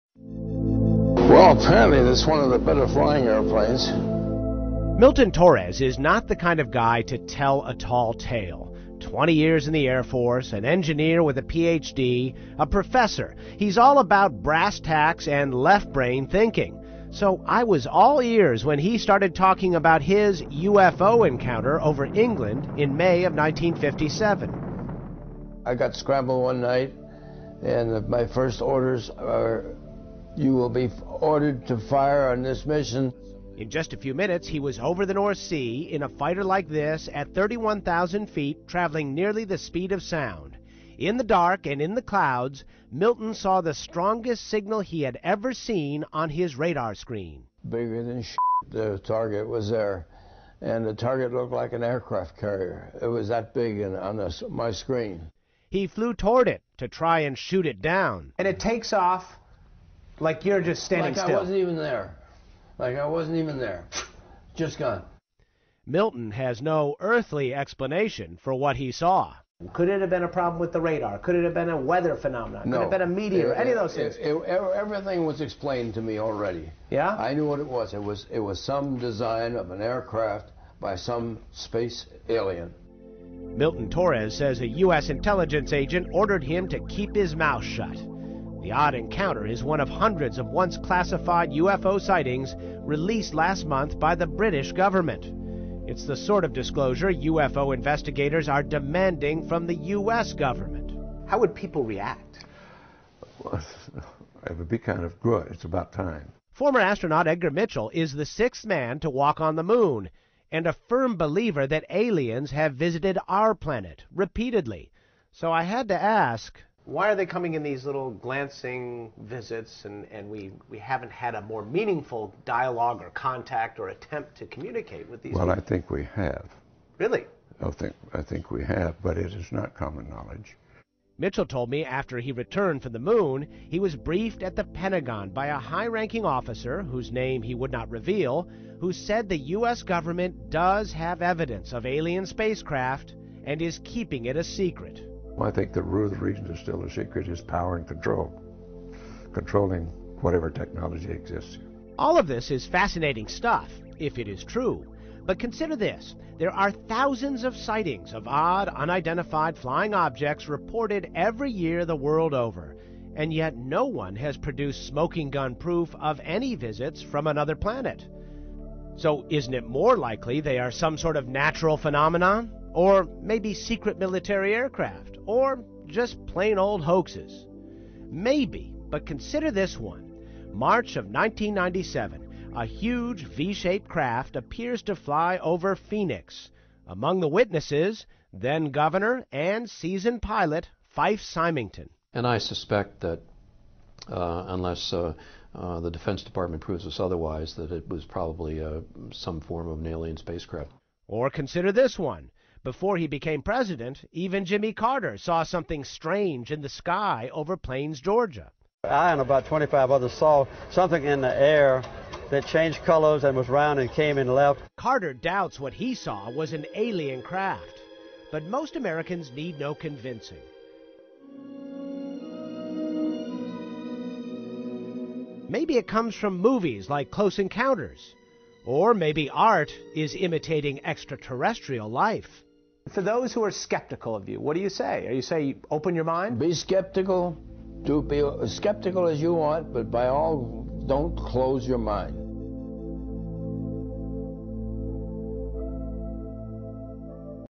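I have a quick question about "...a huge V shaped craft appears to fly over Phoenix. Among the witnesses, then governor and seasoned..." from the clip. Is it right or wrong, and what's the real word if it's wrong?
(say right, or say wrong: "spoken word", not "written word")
right.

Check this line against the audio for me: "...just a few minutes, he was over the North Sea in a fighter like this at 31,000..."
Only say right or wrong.
right.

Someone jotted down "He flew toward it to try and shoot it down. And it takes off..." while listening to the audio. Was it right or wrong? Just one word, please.
right.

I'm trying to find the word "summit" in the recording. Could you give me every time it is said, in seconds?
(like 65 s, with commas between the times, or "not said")
not said.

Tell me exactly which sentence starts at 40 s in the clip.
In the dark and in the clouds, Milton saw the strongest signal he had ever seen on his radar screen.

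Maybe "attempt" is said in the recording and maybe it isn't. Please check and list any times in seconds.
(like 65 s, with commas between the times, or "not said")
123 s.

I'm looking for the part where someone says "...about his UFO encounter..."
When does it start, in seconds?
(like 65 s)
19 s.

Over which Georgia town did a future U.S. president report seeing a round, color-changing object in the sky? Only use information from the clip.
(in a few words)
Plains.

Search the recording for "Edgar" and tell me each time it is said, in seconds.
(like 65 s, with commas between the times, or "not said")
107 s.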